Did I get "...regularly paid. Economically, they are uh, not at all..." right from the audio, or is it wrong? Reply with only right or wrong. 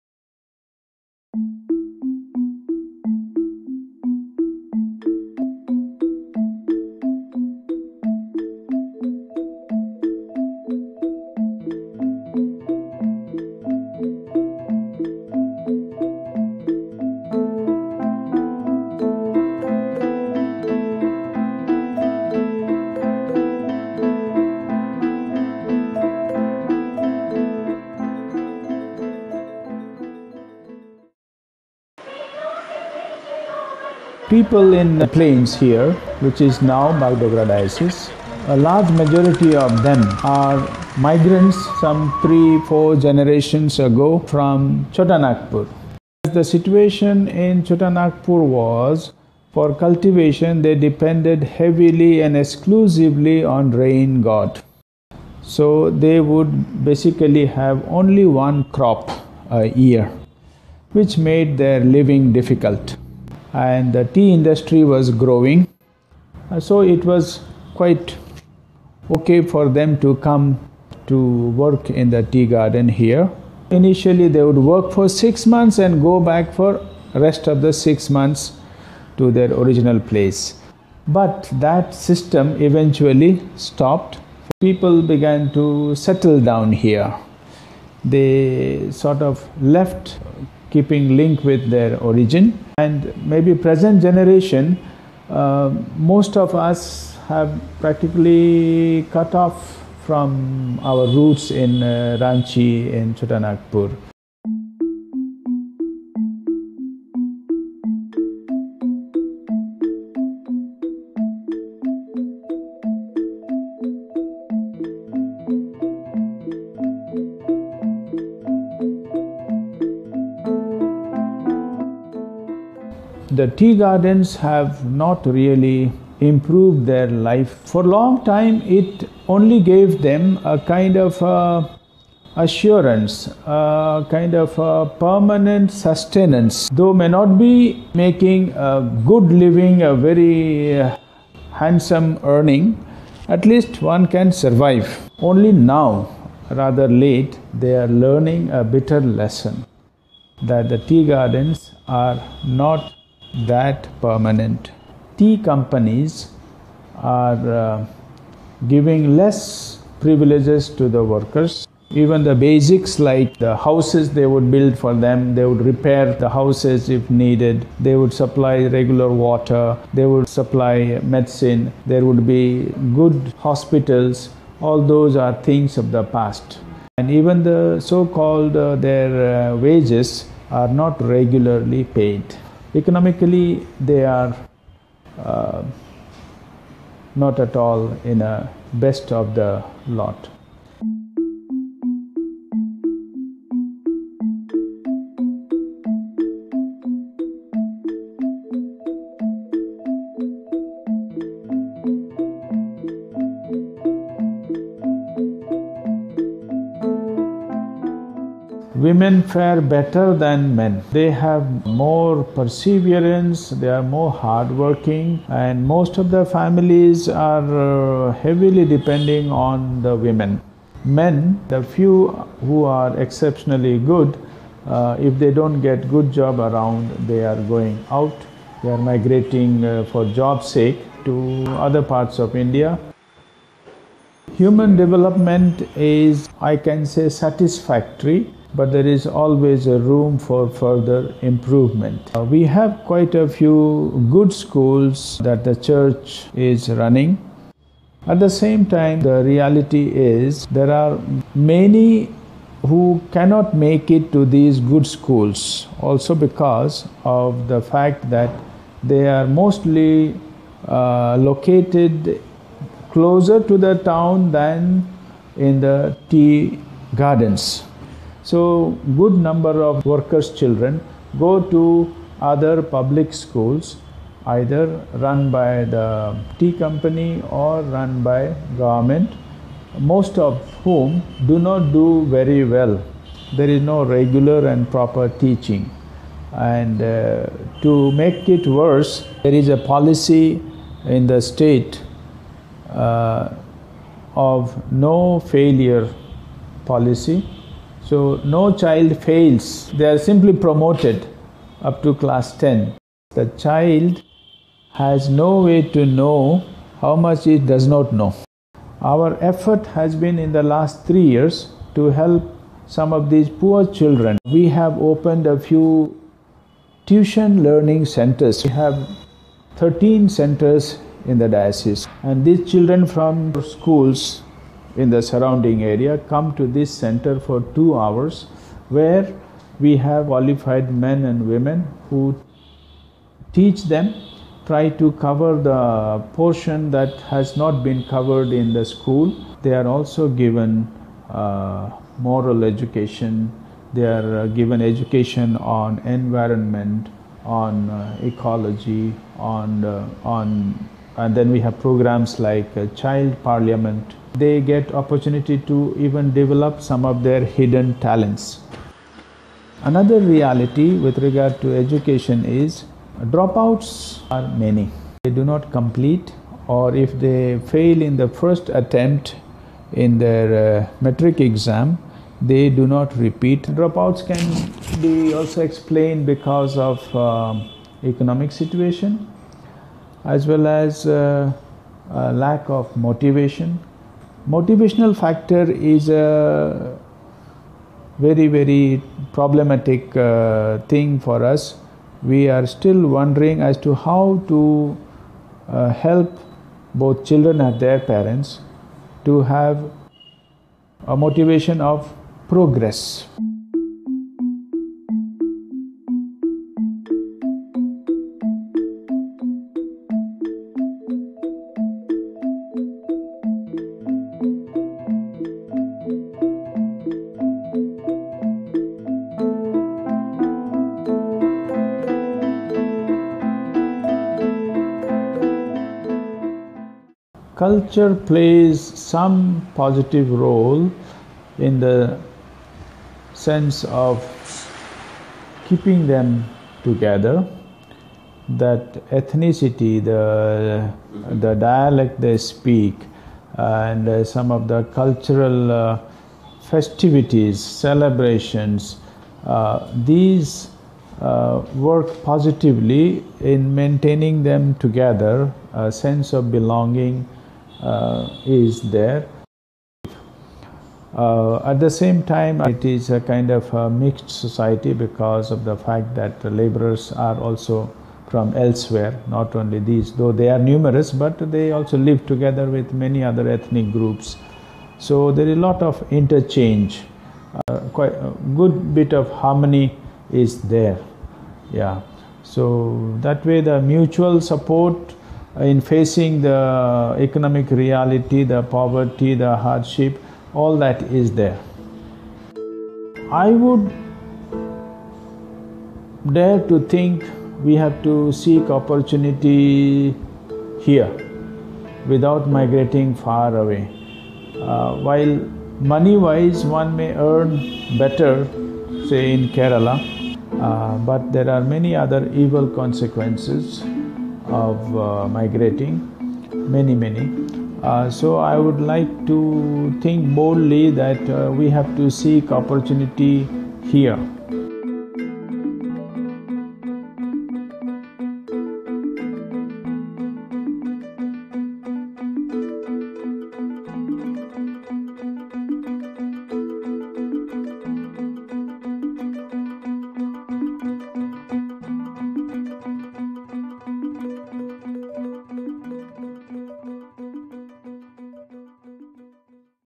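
right.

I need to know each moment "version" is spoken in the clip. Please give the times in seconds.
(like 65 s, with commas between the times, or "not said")
not said.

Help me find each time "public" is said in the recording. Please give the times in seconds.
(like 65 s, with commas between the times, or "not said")
272 s.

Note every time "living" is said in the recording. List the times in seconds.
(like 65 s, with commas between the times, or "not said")
61 s, 139 s.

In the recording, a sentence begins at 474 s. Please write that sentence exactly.
So there is a lot of interchange, uh, quite a uh, good bit of harmony is there.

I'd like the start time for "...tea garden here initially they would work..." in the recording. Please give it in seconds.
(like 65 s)
72 s.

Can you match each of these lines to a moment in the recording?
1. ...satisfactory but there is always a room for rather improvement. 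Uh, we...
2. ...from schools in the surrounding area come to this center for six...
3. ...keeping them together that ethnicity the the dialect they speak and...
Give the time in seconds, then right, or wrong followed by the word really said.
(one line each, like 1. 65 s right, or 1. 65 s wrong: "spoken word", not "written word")
1. 237 s wrong: "further", not "rather"
2. 322 s wrong: "two", not "six"
3. 435 s right.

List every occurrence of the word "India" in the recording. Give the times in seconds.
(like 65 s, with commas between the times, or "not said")
232 s.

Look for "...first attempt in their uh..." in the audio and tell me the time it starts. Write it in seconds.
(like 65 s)
368 s.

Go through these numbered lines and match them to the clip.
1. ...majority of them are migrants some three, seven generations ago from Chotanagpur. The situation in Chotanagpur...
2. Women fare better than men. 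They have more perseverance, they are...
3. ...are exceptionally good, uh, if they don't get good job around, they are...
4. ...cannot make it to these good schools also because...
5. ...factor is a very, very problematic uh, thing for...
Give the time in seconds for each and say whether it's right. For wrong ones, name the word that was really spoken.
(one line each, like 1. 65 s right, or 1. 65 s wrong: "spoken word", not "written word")
1. 38 s wrong: "four", not "seven"
2. 208 s right
3. 222 s right
4. 253 s right
5. 384 s right.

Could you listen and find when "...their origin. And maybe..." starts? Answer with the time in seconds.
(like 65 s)
91 s.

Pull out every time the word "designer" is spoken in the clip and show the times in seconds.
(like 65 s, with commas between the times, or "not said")
not said.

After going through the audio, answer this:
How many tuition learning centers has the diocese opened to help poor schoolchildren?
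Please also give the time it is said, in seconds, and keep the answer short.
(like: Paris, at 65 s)
13, at 319 s.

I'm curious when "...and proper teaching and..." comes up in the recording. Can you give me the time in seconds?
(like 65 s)
284 s.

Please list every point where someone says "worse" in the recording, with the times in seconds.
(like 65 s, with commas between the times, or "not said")
288 s.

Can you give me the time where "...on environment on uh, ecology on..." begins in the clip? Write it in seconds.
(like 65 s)
345 s.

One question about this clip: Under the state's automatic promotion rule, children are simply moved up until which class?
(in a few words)
Class 10.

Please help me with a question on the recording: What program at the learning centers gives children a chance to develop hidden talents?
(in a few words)
Child parliament.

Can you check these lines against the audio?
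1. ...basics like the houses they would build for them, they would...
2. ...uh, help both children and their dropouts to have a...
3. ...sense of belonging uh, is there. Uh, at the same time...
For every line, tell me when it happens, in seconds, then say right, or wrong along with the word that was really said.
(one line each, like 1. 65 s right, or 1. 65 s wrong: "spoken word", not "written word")
1. 162 s right
2. 395 s wrong: "parents", not "dropouts"
3. 455 s right.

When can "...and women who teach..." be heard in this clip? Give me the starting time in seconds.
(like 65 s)
331 s.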